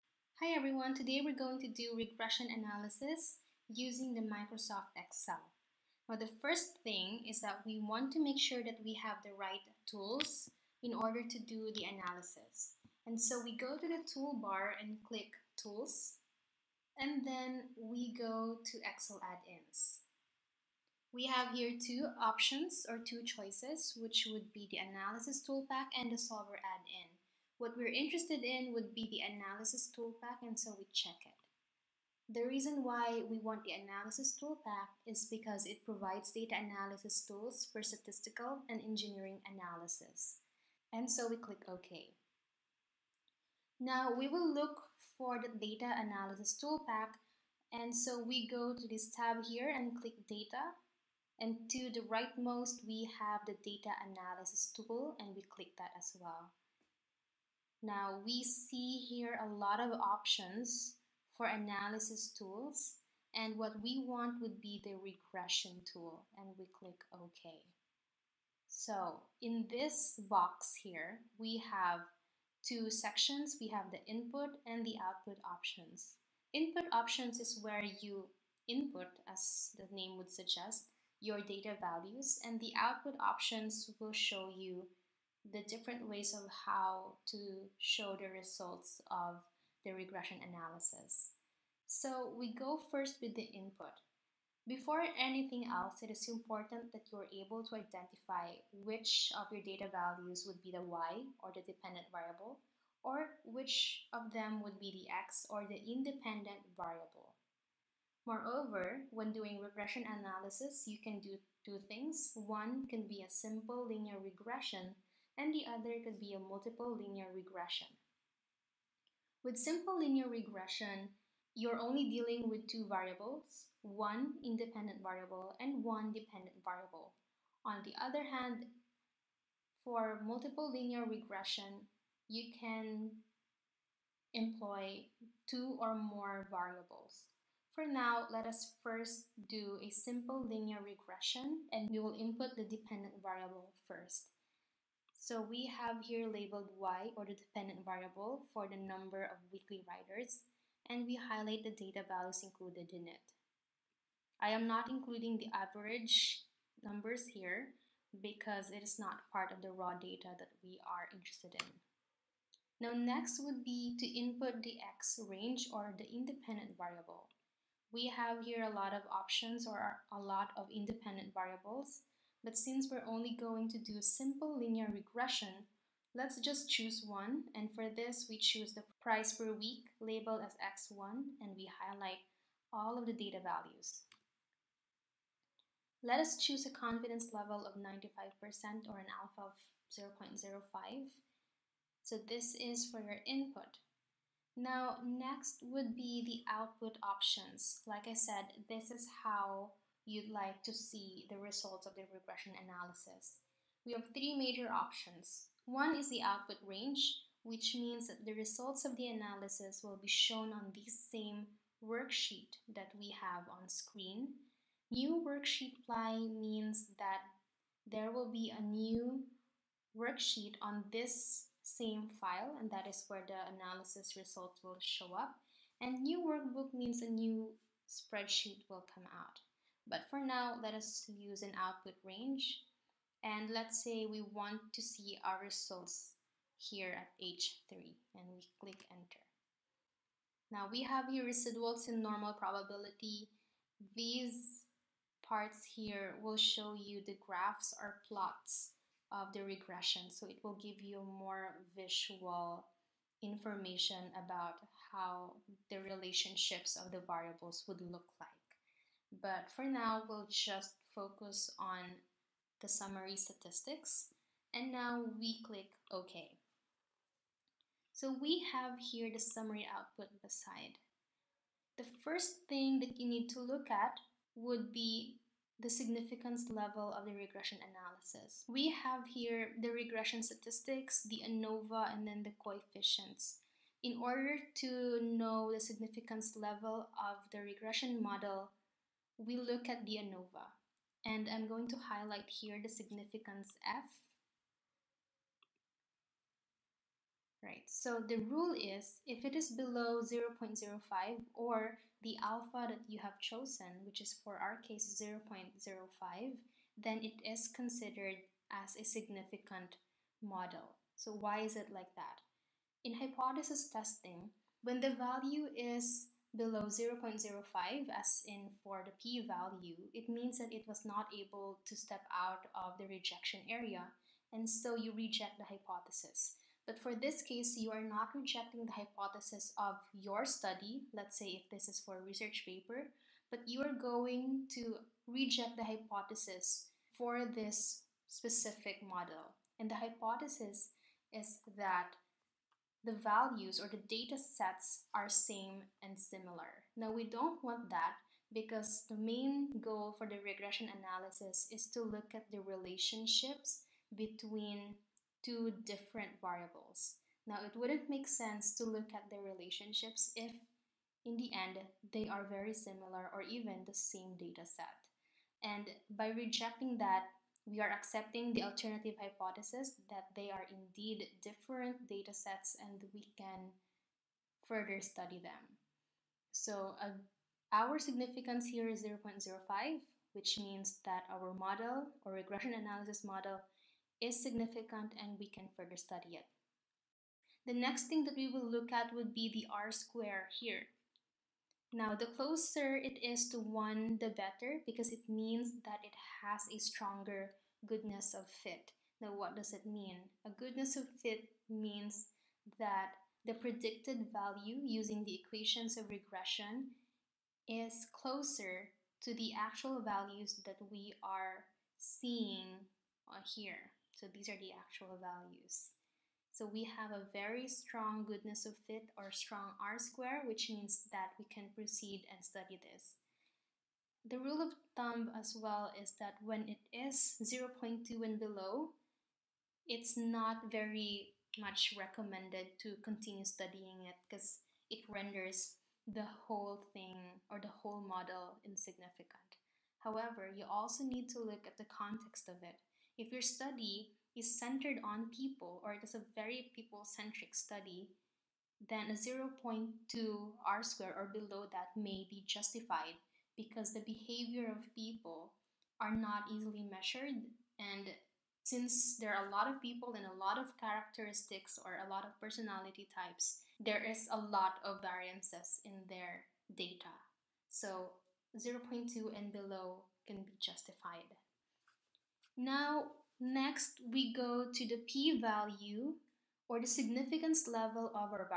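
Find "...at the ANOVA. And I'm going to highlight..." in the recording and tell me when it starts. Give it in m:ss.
4:49.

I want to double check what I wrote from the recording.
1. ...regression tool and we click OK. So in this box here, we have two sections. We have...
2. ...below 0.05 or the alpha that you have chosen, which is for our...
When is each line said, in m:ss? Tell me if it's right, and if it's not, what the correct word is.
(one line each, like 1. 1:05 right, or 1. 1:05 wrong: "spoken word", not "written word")
1. 1:04 right
2. 4:59 right.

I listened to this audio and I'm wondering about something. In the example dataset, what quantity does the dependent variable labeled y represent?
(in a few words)
number of weekly riders.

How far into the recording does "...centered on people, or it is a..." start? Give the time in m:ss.
7:24.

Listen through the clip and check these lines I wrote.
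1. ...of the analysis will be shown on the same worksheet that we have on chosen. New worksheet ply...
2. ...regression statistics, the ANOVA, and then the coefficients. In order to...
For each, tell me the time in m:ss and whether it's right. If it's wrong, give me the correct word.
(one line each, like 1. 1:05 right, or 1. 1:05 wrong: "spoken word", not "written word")
1. 3:28 wrong: "screen", not "chosen"
2. 4:39 right.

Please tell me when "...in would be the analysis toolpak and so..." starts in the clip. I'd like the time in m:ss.
0:28.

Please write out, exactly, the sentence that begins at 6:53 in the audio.
So these are the actual values.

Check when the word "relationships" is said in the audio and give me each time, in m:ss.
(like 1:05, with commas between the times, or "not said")
4:15, 5:52, 5:59.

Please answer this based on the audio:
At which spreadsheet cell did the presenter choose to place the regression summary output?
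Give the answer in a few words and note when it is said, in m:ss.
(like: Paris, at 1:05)
H3, at 3:57.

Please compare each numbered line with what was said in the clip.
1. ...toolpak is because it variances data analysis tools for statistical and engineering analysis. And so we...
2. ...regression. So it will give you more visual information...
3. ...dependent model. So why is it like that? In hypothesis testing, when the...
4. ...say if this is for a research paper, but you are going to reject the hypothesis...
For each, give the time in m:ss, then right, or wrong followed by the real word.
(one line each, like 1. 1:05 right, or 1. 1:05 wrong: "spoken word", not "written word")
1. 0:34 wrong: "provides", not "variances"
2. 4:09 right
3. 5:08 wrong: "significant", not "dependent"
4. 5:31 right.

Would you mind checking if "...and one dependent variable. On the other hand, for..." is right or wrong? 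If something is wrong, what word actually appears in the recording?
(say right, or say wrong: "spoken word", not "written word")
right.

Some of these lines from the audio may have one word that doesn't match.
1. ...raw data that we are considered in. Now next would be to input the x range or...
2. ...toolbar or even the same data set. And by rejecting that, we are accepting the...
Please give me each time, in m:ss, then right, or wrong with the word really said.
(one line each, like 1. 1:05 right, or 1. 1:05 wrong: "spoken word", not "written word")
1. 2:39 wrong: "interested", not "considered"
2. 6:02 wrong: "similar", not "toolbar".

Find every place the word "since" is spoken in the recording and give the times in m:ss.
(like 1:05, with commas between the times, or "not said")
2:52, 7:38.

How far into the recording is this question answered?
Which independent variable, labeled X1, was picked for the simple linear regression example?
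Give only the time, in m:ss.
2:59.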